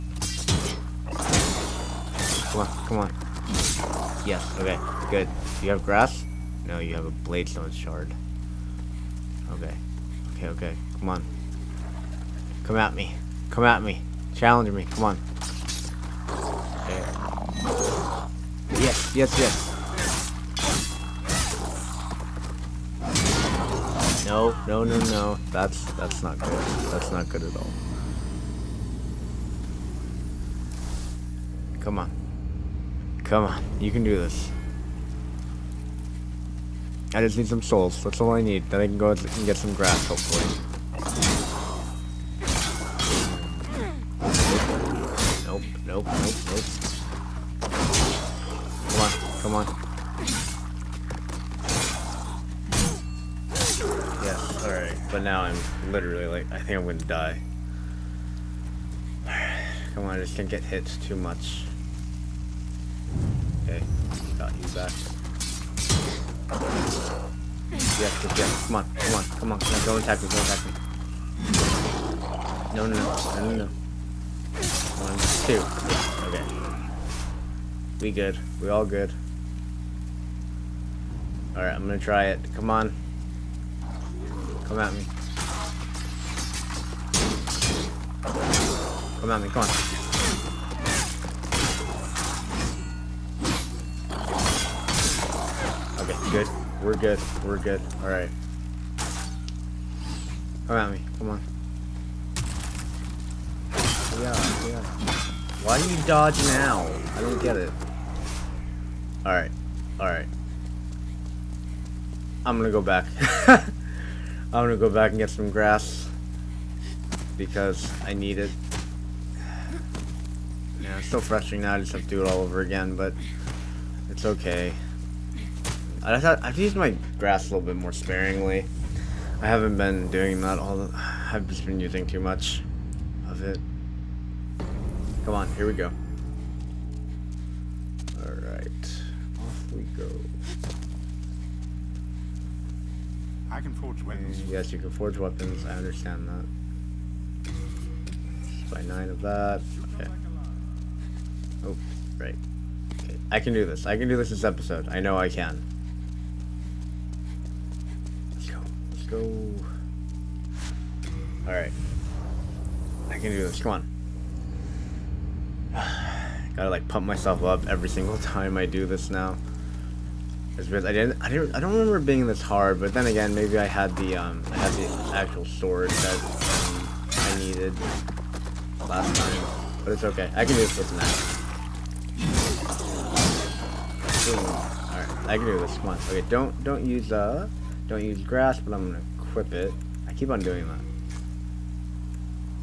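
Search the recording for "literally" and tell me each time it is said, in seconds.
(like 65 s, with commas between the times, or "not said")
55 s.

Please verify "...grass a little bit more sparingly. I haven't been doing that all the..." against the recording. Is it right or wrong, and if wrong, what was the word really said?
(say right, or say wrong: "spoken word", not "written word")
right.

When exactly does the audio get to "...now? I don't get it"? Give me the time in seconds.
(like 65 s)
106 s.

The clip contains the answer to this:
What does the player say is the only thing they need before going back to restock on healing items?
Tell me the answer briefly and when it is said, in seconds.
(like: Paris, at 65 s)
Souls, at 37 s.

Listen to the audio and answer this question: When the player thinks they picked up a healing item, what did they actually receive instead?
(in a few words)
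Bladestone shard.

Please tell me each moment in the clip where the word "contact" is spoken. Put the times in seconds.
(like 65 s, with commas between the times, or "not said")
not said.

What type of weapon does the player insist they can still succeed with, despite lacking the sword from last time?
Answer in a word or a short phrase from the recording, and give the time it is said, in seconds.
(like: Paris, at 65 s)
An axe, at 180 s.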